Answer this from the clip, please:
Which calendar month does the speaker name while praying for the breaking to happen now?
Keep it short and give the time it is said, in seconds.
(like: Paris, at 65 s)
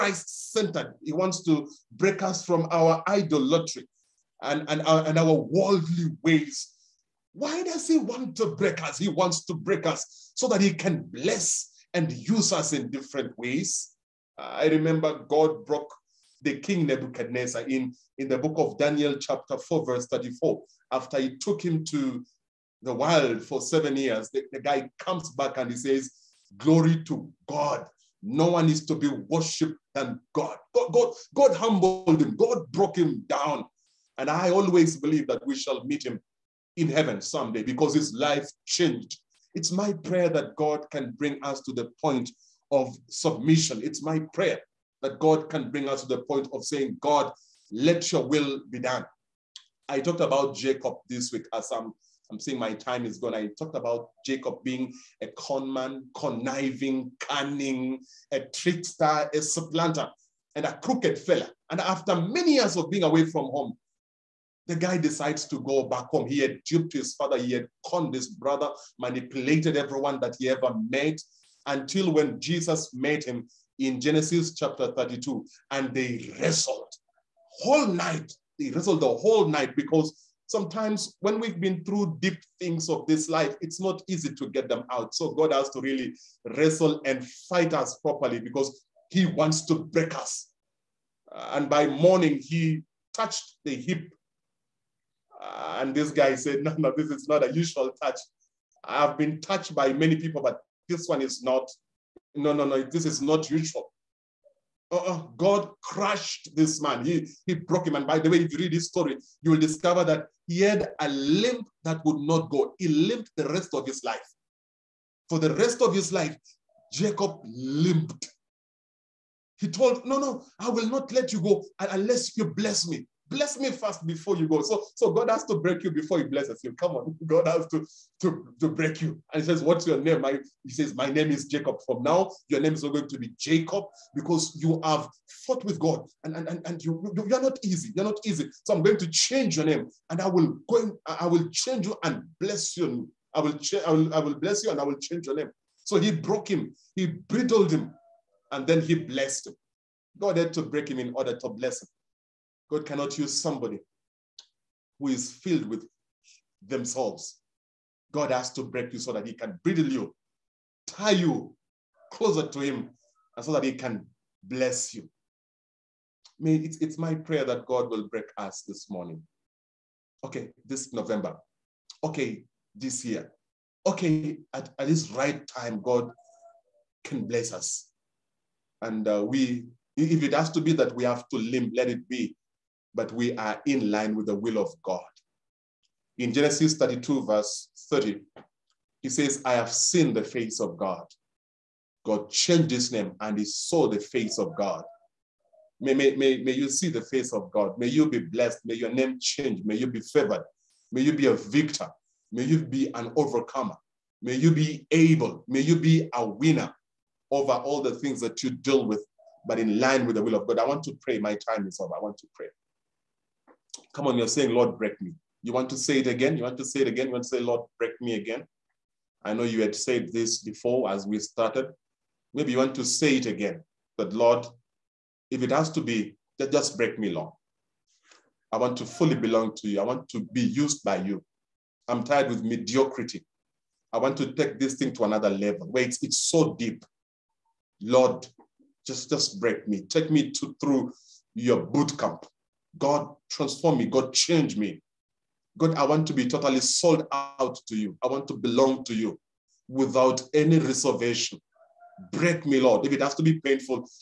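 November, at 170 s.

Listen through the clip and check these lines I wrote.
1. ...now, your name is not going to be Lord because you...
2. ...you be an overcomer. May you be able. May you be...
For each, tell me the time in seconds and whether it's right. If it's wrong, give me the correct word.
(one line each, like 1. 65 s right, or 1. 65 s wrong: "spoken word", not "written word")
1. 132 s wrong: "Jacob", not "Lord"
2. 202 s right.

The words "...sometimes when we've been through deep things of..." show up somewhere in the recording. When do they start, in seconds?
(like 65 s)
80 s.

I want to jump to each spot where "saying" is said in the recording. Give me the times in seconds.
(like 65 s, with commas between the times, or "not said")
46 s, 52 s, 214 s.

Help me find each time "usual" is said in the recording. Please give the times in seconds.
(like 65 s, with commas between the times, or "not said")
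97 s, 103 s.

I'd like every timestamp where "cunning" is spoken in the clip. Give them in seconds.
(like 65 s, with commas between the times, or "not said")
57 s.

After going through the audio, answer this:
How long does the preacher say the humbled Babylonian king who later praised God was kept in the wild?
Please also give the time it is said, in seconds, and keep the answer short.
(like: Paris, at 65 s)
7 years, at 23 s.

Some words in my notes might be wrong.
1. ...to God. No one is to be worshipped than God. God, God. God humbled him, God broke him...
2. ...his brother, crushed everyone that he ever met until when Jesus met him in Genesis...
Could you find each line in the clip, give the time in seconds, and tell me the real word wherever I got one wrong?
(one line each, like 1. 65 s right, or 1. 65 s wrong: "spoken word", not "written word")
1. 27 s right
2. 68 s wrong: "manipulated", not "crushed".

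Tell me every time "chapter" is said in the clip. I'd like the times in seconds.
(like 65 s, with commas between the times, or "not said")
19 s, 74 s.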